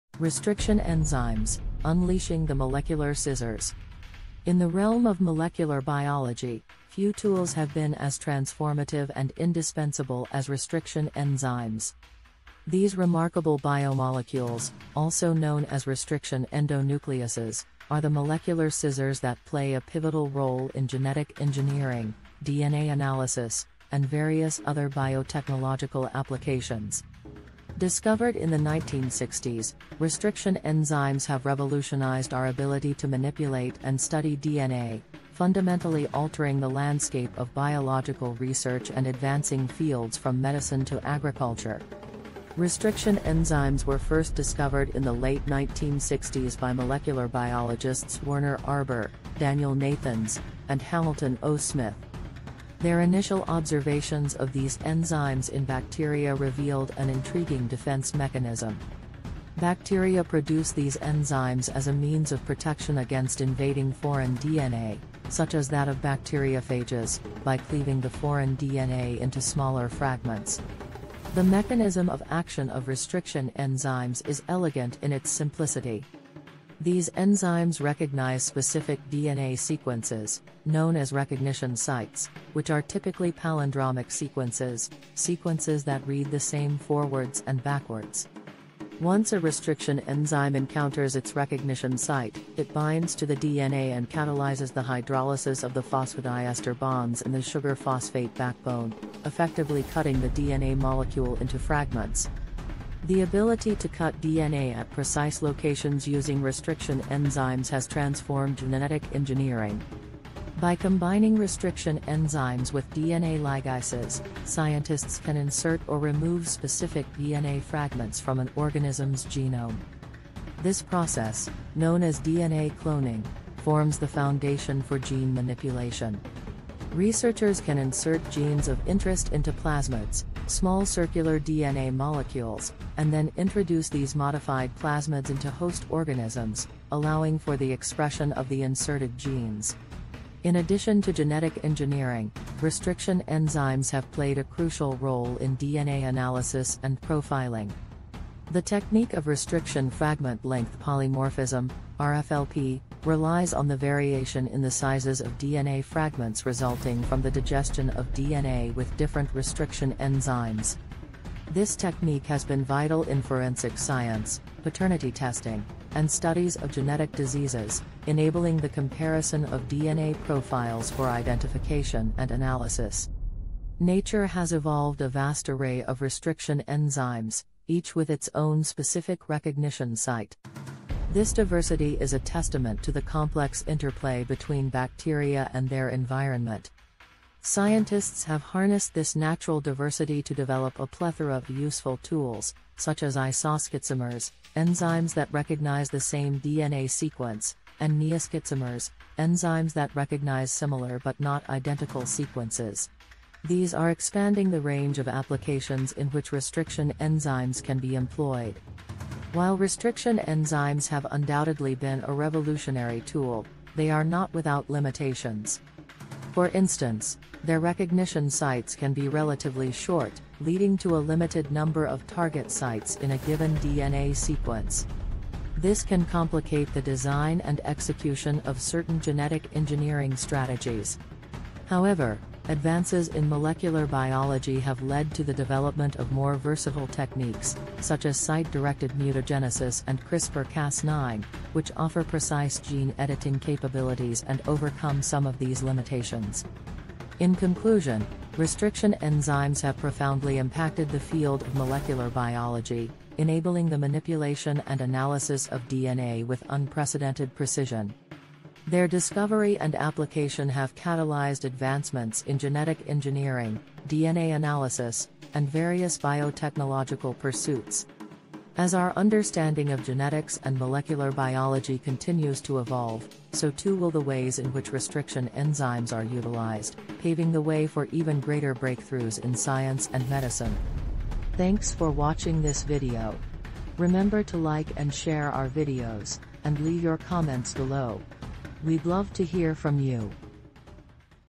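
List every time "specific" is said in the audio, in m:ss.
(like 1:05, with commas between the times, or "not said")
1:18, 1:56, 2:58.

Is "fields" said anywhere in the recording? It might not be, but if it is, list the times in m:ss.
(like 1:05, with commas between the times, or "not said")
0:39, 4:10.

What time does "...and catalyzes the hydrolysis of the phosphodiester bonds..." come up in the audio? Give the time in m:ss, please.
1:33.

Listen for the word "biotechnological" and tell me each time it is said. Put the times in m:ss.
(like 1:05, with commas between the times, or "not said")
0:24, 4:25.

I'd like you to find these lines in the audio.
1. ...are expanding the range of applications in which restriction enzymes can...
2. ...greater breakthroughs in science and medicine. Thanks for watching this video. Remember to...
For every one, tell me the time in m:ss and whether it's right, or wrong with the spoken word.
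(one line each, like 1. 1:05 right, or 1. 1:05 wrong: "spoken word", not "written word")
1. 3:23 right
2. 4:38 right.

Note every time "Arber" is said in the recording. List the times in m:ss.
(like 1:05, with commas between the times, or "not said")
0:48.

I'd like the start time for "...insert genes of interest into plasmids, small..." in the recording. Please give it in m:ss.
2:07.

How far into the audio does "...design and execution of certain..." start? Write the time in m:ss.
3:46.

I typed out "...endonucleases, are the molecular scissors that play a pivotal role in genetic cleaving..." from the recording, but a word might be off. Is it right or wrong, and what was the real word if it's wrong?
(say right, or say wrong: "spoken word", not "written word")
wrong: "engineering", not "cleaving".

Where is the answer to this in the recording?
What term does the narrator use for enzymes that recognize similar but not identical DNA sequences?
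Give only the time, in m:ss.
3:18.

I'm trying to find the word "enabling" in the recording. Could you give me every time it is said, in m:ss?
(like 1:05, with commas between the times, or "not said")
2:48, 4:13.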